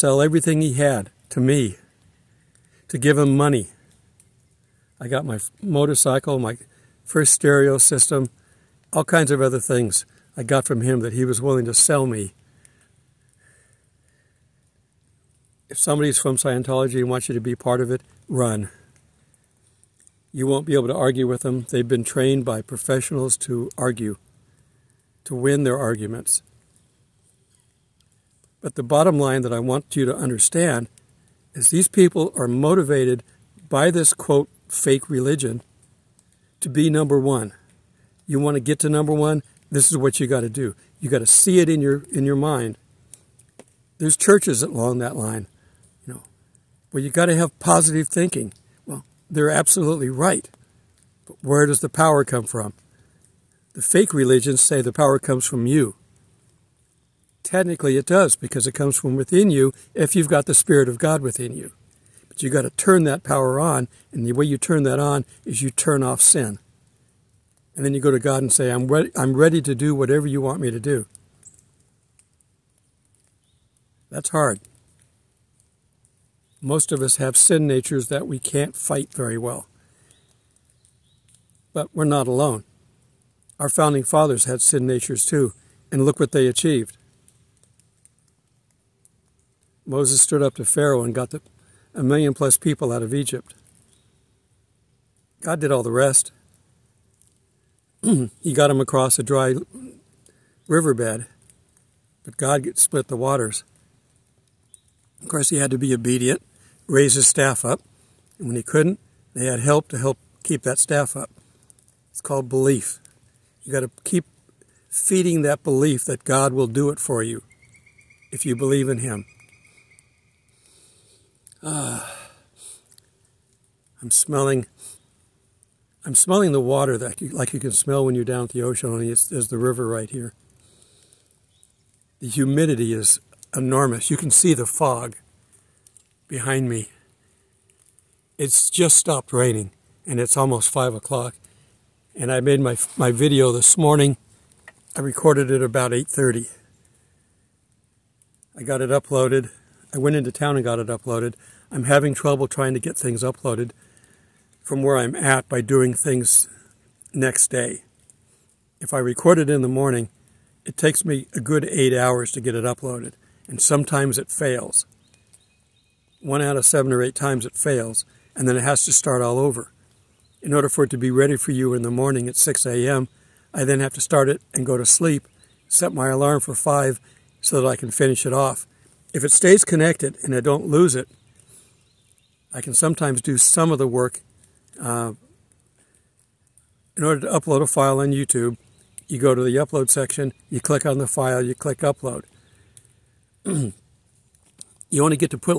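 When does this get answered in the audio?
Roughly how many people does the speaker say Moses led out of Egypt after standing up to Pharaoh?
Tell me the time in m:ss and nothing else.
1:31.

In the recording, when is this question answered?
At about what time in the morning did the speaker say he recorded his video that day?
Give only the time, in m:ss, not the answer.
2:25.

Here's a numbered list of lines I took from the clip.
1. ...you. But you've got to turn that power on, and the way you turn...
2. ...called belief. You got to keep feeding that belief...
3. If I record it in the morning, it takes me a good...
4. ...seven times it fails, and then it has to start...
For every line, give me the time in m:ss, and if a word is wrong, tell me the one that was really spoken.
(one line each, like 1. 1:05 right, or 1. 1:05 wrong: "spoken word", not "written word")
1. 1:01 right
2. 1:52 right
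3. 2:38 right
4. 2:47 wrong: "eight", not "seven".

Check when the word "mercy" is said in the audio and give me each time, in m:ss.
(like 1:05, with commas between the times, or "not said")
not said.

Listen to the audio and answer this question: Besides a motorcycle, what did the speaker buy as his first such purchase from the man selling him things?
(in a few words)
stereo system.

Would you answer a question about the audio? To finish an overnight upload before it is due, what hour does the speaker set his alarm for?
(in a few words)
5.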